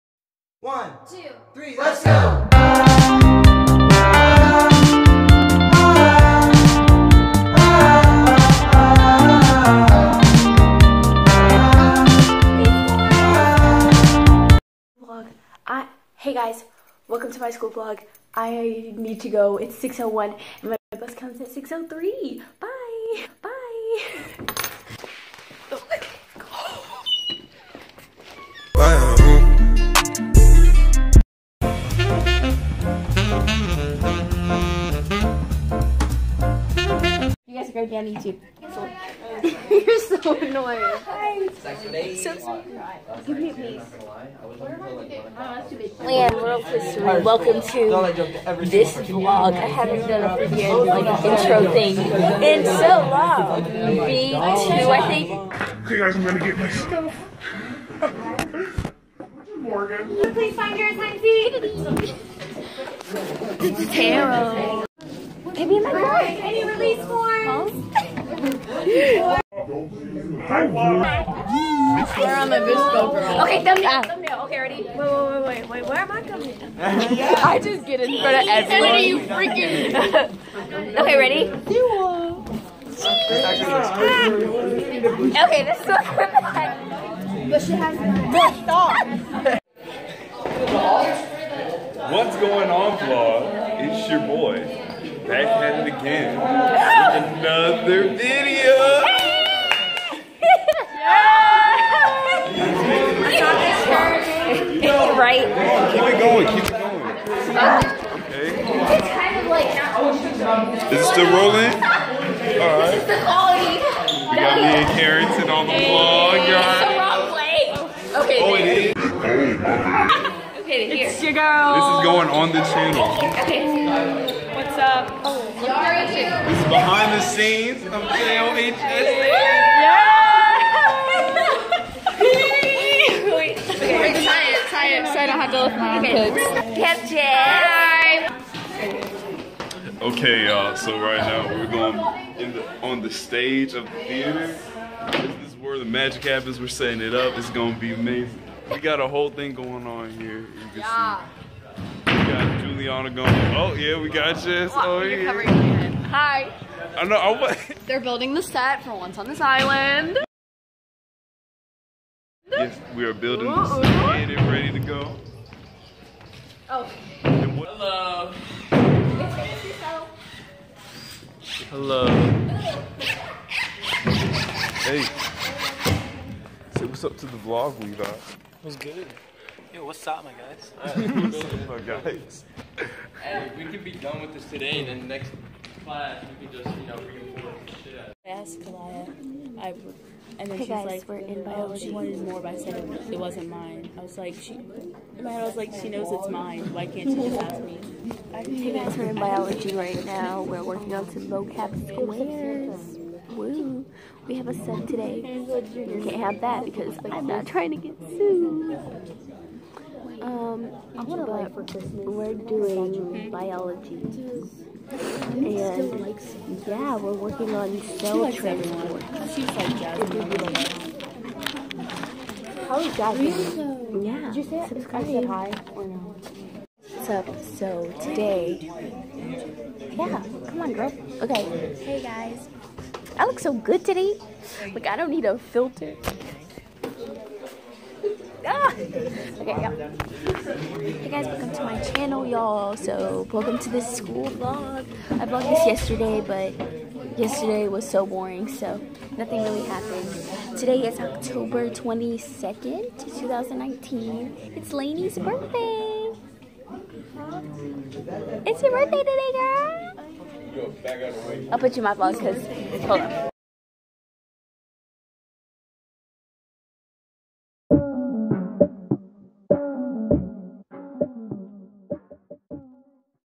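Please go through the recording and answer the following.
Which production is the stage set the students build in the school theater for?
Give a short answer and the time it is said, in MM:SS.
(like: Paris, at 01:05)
Once on This Island, at 02:38.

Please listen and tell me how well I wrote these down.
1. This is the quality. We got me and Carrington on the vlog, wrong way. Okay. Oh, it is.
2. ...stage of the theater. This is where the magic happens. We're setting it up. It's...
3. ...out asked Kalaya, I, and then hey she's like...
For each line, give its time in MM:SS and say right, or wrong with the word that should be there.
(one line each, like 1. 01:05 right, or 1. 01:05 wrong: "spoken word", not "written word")
1. 01:52 right
2. 02:23 right
3. 03:07 right.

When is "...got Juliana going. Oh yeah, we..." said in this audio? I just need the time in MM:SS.
02:32.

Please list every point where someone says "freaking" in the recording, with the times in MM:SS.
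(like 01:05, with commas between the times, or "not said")
00:50, 01:19.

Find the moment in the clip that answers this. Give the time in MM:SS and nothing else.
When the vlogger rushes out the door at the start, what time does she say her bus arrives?
00:21.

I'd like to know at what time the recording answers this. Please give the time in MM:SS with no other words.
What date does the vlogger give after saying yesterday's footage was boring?
04:10.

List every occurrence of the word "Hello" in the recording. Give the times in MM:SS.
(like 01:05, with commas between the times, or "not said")
02:47, 02:51.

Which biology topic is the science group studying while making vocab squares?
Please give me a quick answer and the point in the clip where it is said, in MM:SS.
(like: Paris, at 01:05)
cell transport, at 03:37.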